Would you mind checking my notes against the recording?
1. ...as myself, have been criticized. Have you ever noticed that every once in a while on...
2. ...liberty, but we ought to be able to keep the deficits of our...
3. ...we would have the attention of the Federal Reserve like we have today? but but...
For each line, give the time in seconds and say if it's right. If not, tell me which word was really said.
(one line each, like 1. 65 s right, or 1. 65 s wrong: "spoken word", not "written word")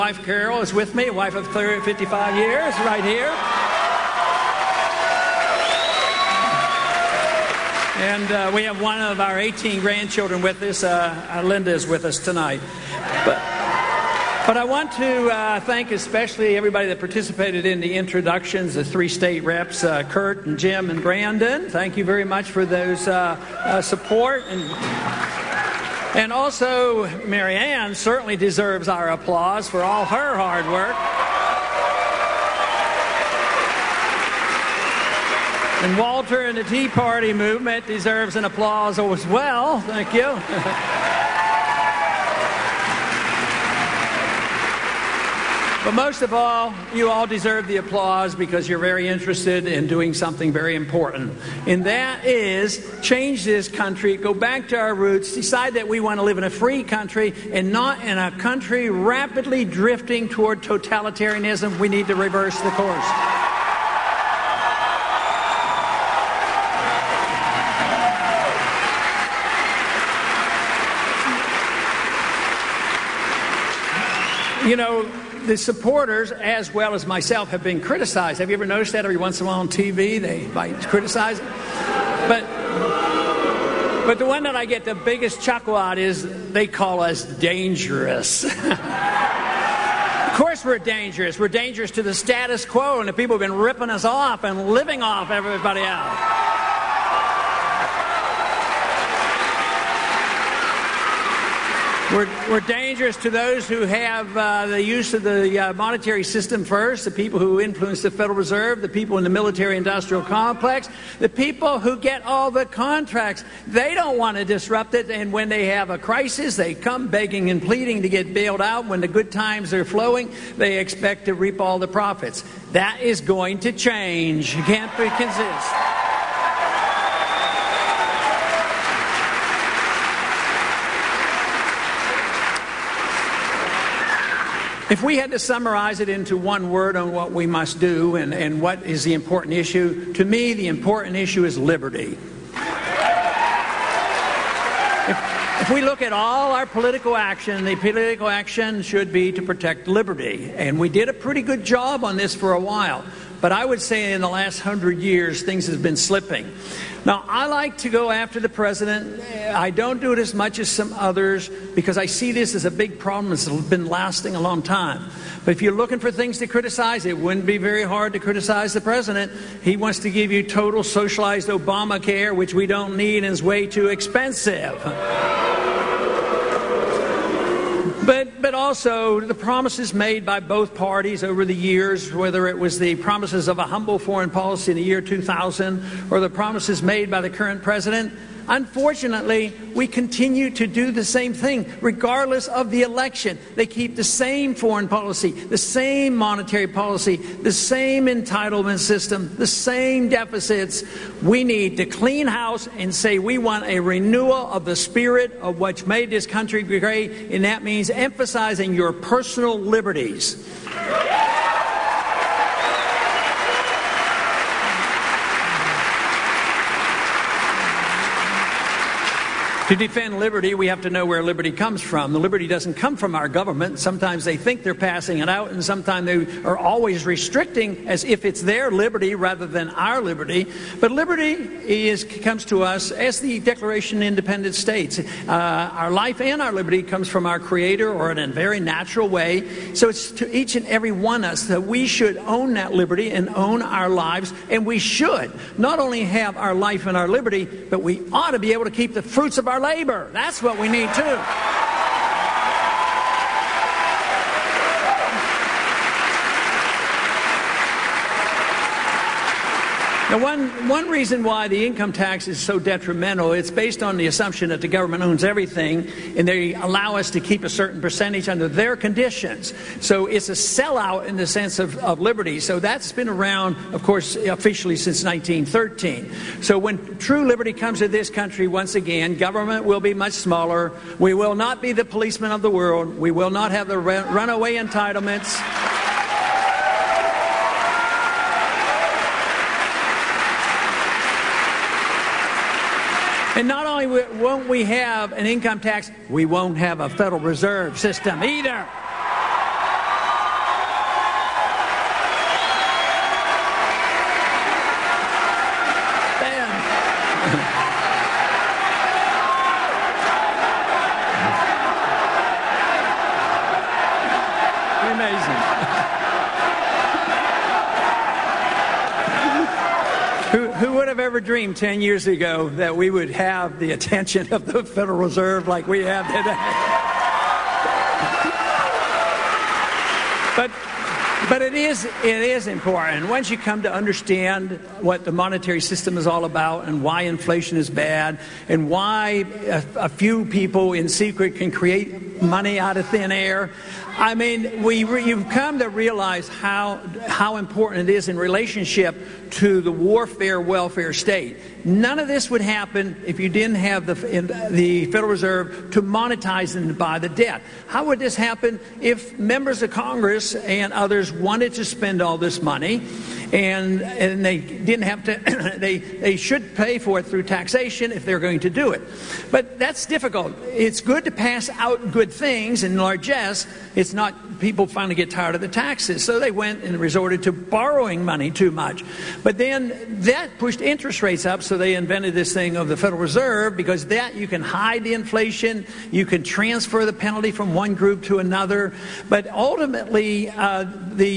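1. 76 s right
2. 247 s wrong: "fruits", not "deficits"
3. 322 s right.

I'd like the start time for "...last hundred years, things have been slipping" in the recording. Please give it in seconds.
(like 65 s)
154 s.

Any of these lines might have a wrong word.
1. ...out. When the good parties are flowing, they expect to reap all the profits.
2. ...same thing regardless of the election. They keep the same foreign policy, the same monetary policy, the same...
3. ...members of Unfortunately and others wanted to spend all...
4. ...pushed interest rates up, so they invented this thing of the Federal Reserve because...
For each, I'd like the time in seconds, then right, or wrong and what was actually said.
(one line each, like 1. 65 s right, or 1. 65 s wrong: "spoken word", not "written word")
1. 118 s wrong: "times", not "parties"
2. 191 s right
3. 359 s wrong: "Congress", not "Unfortunately"
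4. 380 s right.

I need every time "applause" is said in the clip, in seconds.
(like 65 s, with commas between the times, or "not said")
29 s, 38 s, 47 s.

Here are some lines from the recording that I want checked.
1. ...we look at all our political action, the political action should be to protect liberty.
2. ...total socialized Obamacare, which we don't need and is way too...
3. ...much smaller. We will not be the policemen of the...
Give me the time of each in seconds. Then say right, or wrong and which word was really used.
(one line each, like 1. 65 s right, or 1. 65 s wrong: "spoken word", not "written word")
1. 145 s right
2. 170 s right
3. 279 s right.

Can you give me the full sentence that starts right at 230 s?
But liberty is, comes to us as the Declaration of Independence States.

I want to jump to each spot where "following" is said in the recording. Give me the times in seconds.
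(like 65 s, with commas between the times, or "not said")
not said.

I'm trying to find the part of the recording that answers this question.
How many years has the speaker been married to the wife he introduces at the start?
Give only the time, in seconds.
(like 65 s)
1 s.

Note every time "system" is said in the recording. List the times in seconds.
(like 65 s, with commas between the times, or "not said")
106 s, 198 s, 297 s, 335 s.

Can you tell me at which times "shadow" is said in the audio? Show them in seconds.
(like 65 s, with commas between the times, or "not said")
not said.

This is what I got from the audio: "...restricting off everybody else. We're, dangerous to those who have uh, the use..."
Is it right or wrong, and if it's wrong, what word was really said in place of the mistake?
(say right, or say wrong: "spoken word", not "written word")
wrong: "living", not "restricting".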